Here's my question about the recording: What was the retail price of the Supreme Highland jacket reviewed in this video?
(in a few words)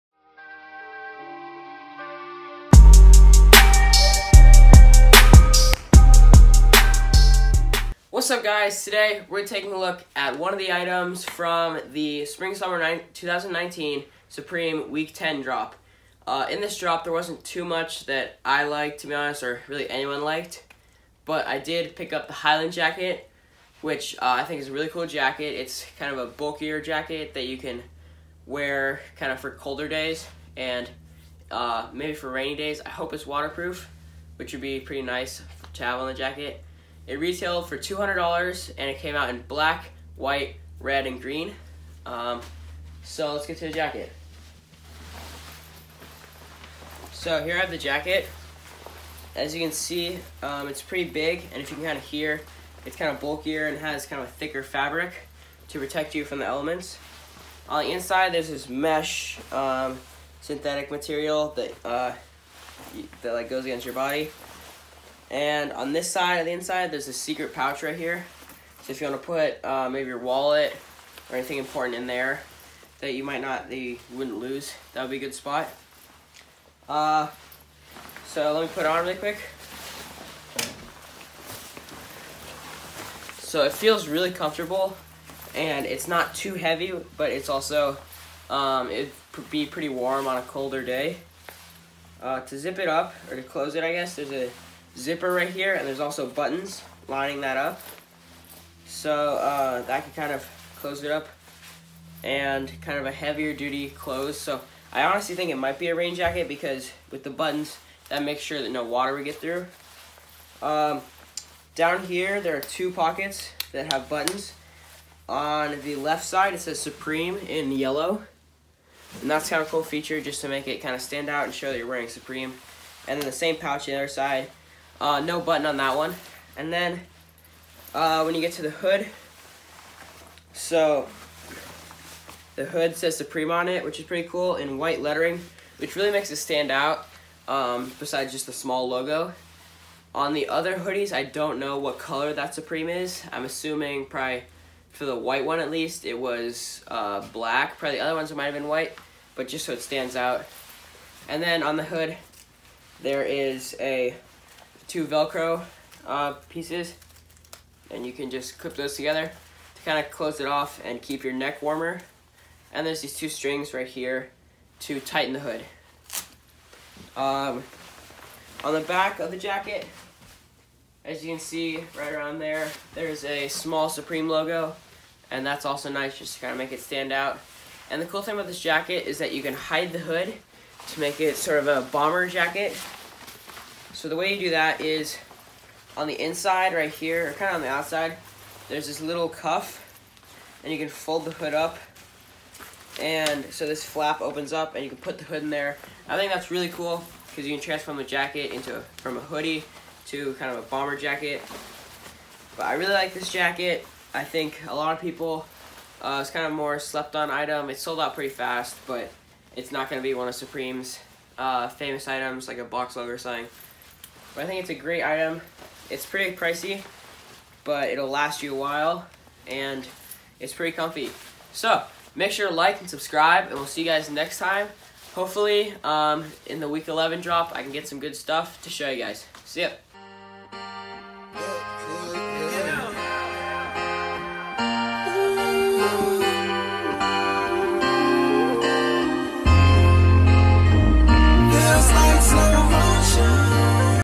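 $200.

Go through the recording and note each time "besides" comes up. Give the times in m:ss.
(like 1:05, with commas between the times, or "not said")
2:17.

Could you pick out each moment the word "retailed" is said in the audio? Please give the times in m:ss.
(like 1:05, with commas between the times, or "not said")
0:37.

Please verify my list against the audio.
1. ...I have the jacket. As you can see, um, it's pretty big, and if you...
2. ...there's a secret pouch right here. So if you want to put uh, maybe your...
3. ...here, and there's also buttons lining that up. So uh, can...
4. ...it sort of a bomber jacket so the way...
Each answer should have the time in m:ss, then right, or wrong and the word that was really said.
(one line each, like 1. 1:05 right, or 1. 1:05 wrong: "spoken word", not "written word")
1. 0:47 right
2. 1:06 right
3. 1:35 right
4. 3:01 right.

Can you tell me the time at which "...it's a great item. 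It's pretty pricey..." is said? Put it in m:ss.
3:34.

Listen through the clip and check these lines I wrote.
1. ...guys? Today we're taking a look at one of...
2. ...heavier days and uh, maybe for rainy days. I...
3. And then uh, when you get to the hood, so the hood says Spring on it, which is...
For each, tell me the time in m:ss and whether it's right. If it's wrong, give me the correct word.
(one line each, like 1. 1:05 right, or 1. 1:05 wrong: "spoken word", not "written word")
1. 0:08 right
2. 0:29 wrong: "colder", not "heavier"
3. 2:06 wrong: "Supreme", not "Spring".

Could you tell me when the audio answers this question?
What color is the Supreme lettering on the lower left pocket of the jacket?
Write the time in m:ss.
1:57.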